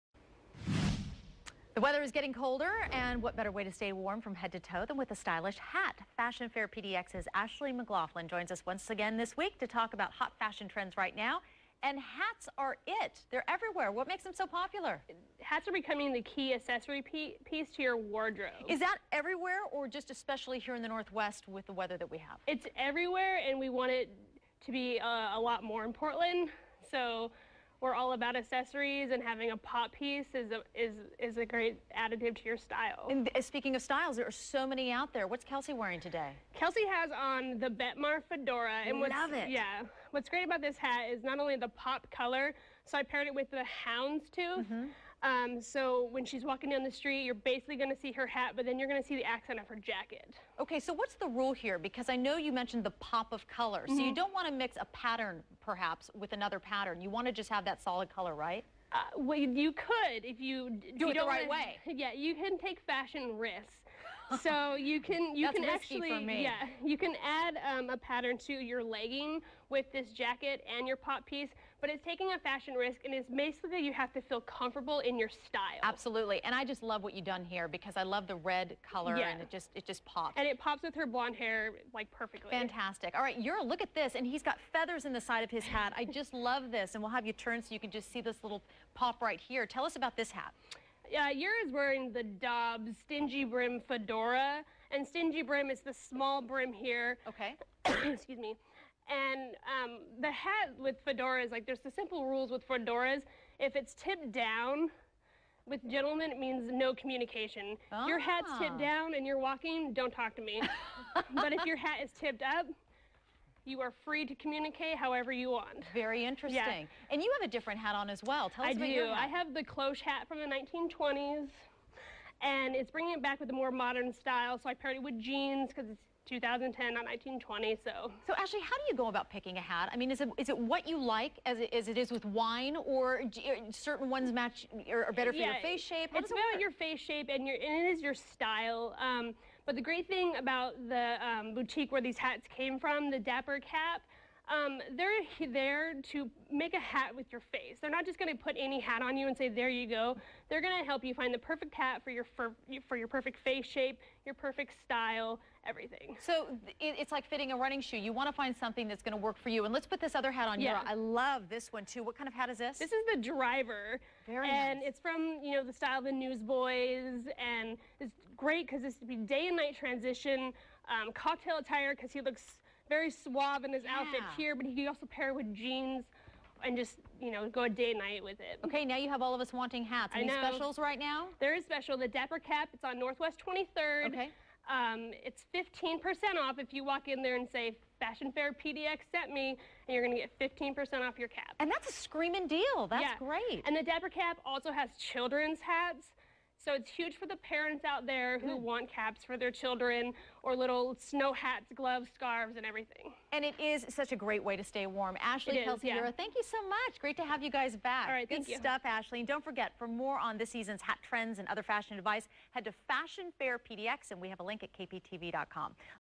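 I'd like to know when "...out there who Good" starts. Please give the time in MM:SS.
03:17.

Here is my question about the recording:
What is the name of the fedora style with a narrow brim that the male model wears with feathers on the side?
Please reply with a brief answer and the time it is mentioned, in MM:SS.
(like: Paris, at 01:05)
Dobbs Stingy Brim, at 01:32.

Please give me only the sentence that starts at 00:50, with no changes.
Okay, so what's the rule here?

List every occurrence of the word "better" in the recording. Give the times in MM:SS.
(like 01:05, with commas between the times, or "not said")
00:03, 02:15.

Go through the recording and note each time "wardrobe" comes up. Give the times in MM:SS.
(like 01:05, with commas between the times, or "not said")
00:17.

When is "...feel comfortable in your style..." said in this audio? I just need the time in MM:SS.
01:14.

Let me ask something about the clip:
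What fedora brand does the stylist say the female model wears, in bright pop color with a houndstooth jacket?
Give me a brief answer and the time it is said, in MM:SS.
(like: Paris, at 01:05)
Betmar, at 00:37.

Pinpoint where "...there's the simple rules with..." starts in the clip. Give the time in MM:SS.
01:41.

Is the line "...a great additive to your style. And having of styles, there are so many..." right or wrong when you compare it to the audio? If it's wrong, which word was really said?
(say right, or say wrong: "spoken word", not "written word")
wrong: "speaking", not "having".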